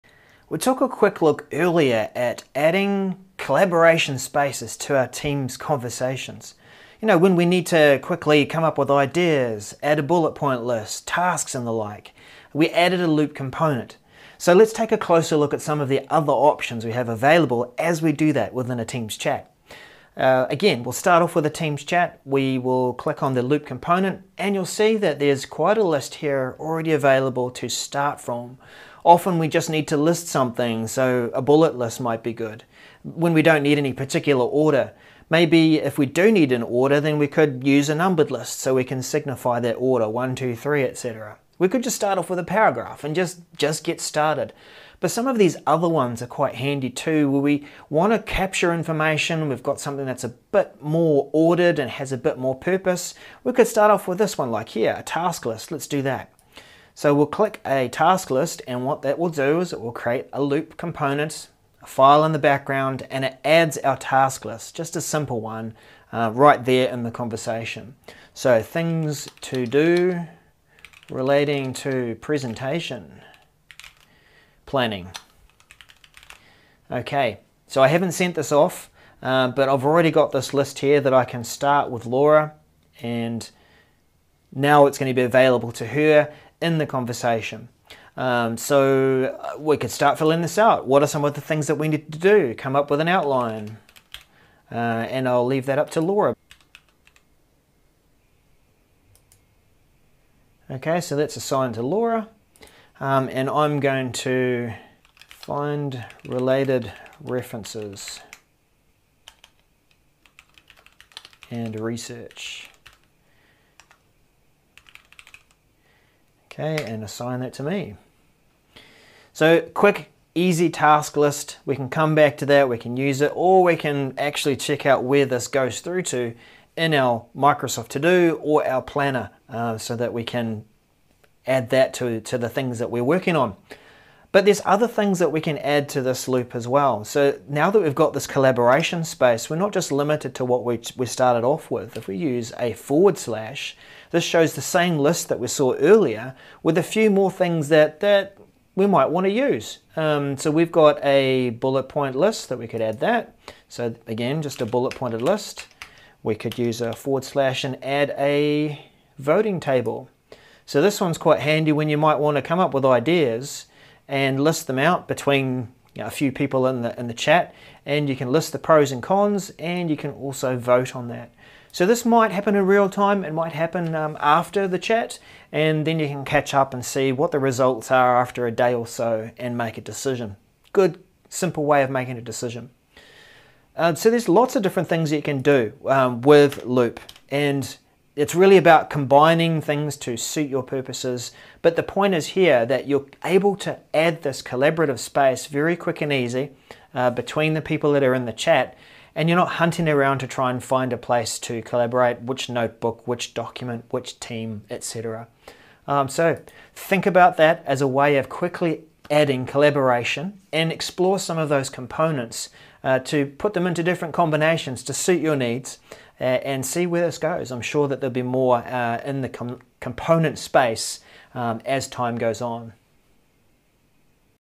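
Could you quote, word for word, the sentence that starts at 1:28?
Um, so uh, we could start filling this out.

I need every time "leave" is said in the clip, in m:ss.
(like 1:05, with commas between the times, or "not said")
1:35.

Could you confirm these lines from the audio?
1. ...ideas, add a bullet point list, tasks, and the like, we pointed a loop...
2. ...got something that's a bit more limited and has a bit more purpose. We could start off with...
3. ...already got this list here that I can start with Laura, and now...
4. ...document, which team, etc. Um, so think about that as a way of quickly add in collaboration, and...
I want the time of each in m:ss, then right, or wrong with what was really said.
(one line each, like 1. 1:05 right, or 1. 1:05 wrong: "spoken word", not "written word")
1. 0:08 wrong: "added", not "pointed"
2. 0:49 wrong: "ordered", not "limited"
3. 1:19 right
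4. 3:23 right.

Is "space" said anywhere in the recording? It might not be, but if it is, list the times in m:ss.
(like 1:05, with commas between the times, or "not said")
0:04, 2:19, 3:14, 3:40.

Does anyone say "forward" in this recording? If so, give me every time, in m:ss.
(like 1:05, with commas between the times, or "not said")
2:22, 2:36.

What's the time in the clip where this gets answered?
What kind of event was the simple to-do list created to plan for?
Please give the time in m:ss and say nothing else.
1:12.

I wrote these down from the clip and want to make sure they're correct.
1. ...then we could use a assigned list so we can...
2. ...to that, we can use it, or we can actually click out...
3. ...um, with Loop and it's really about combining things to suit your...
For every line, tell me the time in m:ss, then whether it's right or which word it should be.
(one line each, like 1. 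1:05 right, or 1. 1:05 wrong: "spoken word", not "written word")
1. 0:36 wrong: "numbered", not "assigned"
2. 2:02 wrong: "check", not "click"
3. 3:05 right.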